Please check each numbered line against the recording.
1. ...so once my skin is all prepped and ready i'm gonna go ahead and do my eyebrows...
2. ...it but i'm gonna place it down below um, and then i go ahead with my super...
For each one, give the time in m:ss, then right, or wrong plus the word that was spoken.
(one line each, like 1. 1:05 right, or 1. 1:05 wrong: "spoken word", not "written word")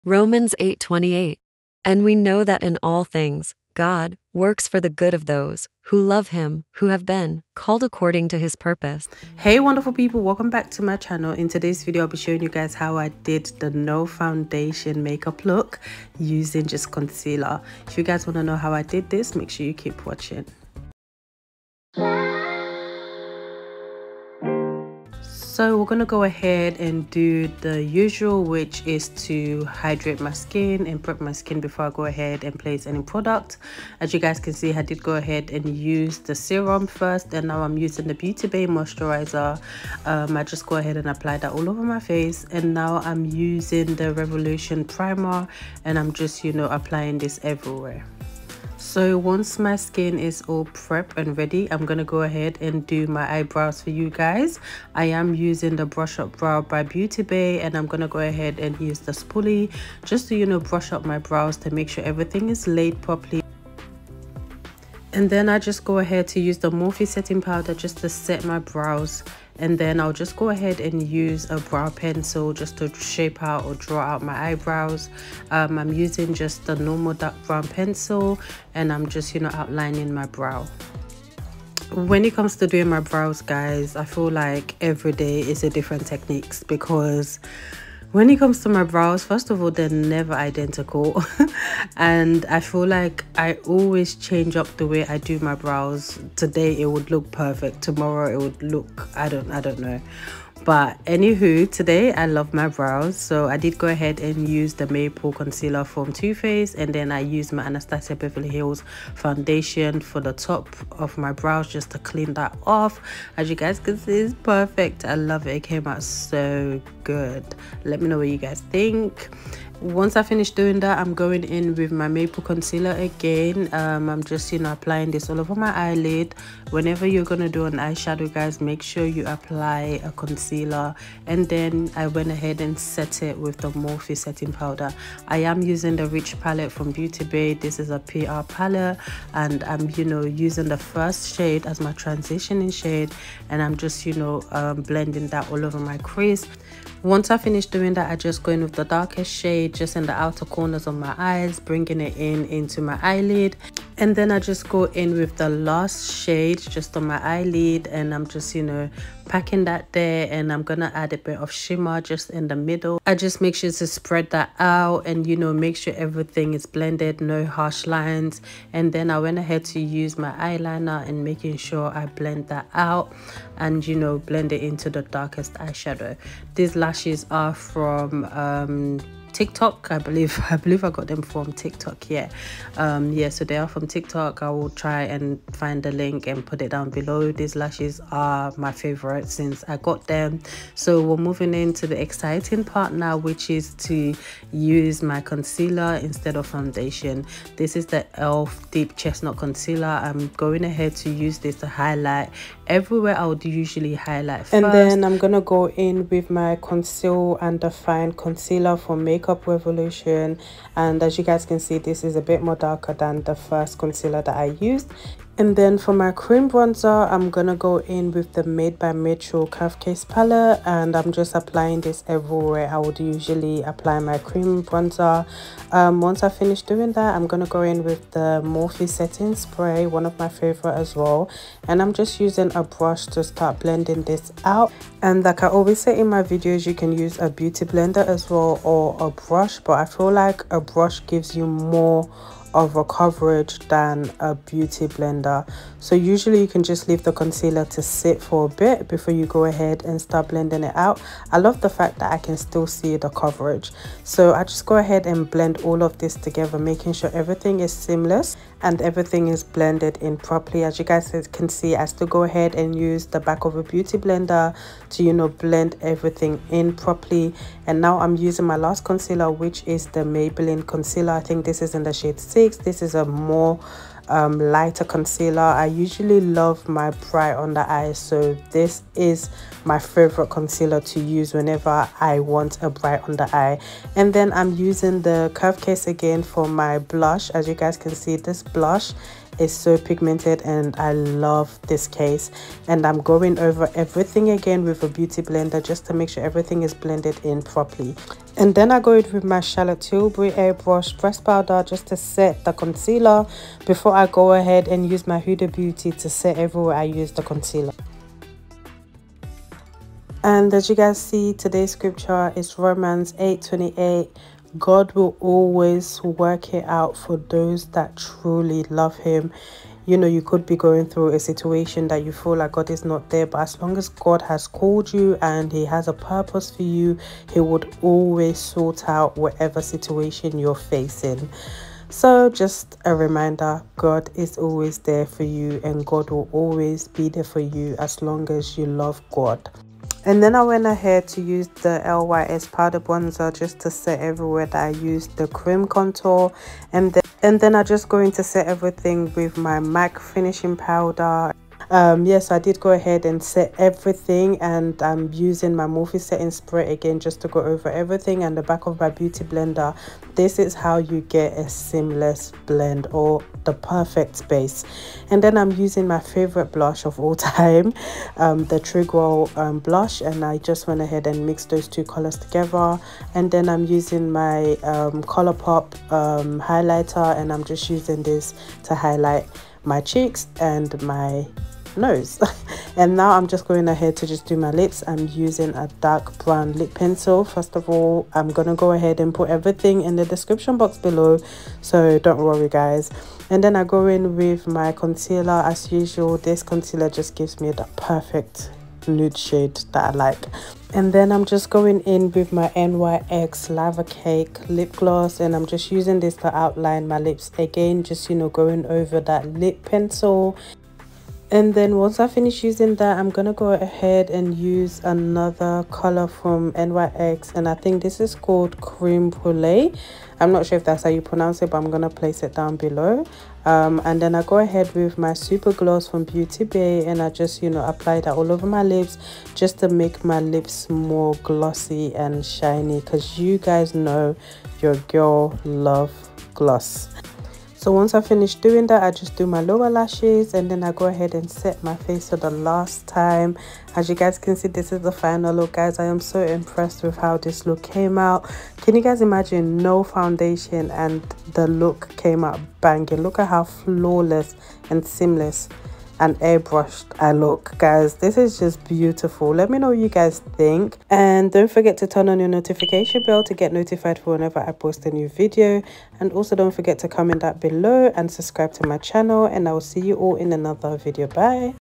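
1. 0:48 right
2. 7:01 right.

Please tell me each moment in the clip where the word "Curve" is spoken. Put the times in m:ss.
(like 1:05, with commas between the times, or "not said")
3:39, 4:45.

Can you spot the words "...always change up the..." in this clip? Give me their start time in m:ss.
1:33.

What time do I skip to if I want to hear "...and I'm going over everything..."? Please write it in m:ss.
4:52.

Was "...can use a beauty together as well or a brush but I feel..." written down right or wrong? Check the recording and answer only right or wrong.
wrong.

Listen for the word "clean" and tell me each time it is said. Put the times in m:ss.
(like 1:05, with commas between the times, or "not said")
1:51.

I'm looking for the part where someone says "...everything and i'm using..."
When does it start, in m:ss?
5:53.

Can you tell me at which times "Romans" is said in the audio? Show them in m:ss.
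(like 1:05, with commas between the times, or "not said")
0:00, 5:12.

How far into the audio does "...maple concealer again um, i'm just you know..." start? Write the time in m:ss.
2:02.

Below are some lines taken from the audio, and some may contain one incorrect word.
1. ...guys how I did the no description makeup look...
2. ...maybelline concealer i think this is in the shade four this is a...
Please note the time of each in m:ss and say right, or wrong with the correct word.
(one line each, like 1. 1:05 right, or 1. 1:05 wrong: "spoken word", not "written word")
1. 0:12 wrong: "foundation", not "description"
2. 4:30 wrong: "six", not "four".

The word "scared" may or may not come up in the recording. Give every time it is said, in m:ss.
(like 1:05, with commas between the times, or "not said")
not said.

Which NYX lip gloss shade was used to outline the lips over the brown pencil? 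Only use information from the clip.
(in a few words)
Lava Cake.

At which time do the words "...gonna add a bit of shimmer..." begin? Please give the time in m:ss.
2:40.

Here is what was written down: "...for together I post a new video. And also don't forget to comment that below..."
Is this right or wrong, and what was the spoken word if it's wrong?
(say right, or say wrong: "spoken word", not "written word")
wrong: "whenever", not "together".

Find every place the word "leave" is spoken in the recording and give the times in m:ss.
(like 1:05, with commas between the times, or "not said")
4:06.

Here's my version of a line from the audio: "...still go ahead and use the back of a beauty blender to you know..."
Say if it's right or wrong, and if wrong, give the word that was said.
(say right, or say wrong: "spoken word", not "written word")
right.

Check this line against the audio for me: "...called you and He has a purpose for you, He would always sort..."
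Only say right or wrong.
right.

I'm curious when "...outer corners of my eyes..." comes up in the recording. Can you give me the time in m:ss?
2:30.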